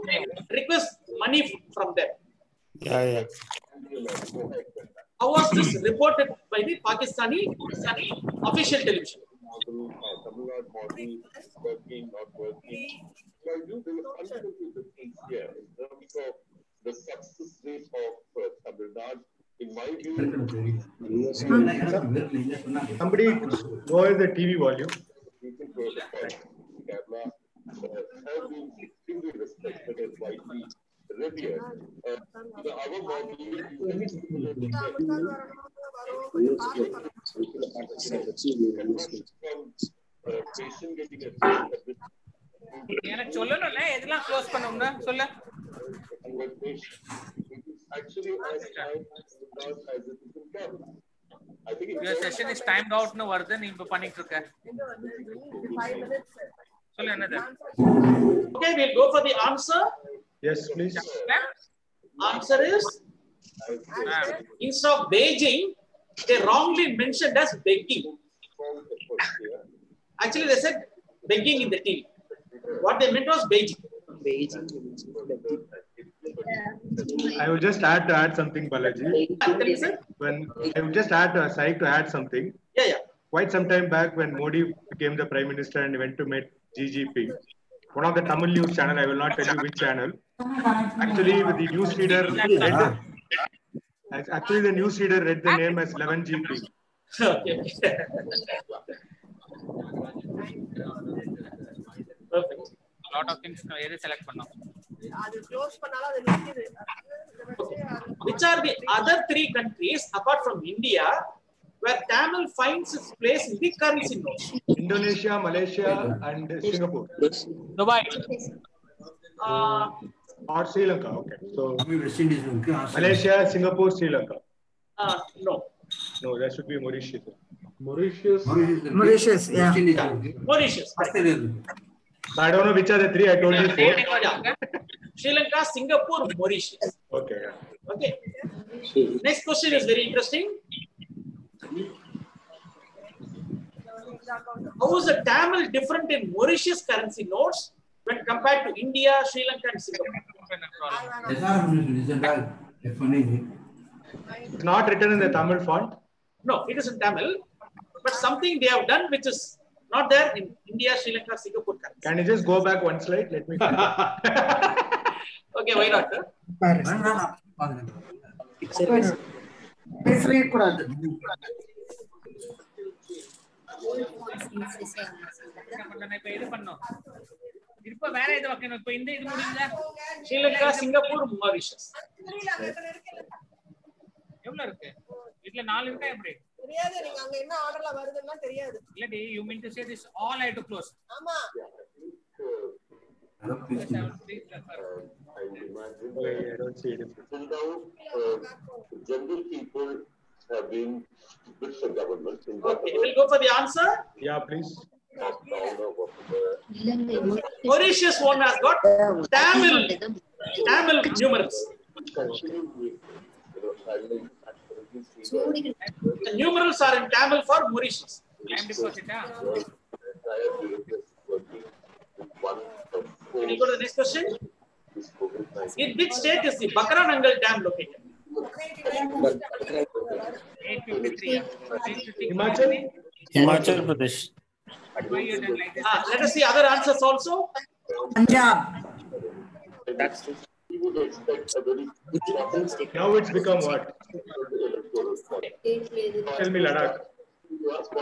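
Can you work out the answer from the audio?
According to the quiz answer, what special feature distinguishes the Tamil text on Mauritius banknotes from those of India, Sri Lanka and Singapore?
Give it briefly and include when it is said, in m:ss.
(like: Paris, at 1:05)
Tamil numerals, at 3:30.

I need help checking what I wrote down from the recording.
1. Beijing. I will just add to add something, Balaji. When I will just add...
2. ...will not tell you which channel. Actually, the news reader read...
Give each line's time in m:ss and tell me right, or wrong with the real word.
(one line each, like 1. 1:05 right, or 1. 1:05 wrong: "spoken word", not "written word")
1. 1:14 right
2. 1:29 right.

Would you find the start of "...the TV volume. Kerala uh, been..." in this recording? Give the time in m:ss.
0:24.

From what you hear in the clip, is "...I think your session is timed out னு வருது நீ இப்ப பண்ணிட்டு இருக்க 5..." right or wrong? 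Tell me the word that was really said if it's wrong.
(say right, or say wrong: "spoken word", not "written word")
right.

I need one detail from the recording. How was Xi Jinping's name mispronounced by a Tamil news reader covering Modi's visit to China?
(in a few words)
11 GP.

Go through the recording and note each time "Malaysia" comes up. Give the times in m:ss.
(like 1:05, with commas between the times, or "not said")
1:55, 2:02.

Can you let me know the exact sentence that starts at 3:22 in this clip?
In okay, we'll go for the answer.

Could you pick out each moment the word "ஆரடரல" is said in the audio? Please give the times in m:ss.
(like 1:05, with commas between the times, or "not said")
3:07.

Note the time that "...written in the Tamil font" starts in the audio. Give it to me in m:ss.
2:34.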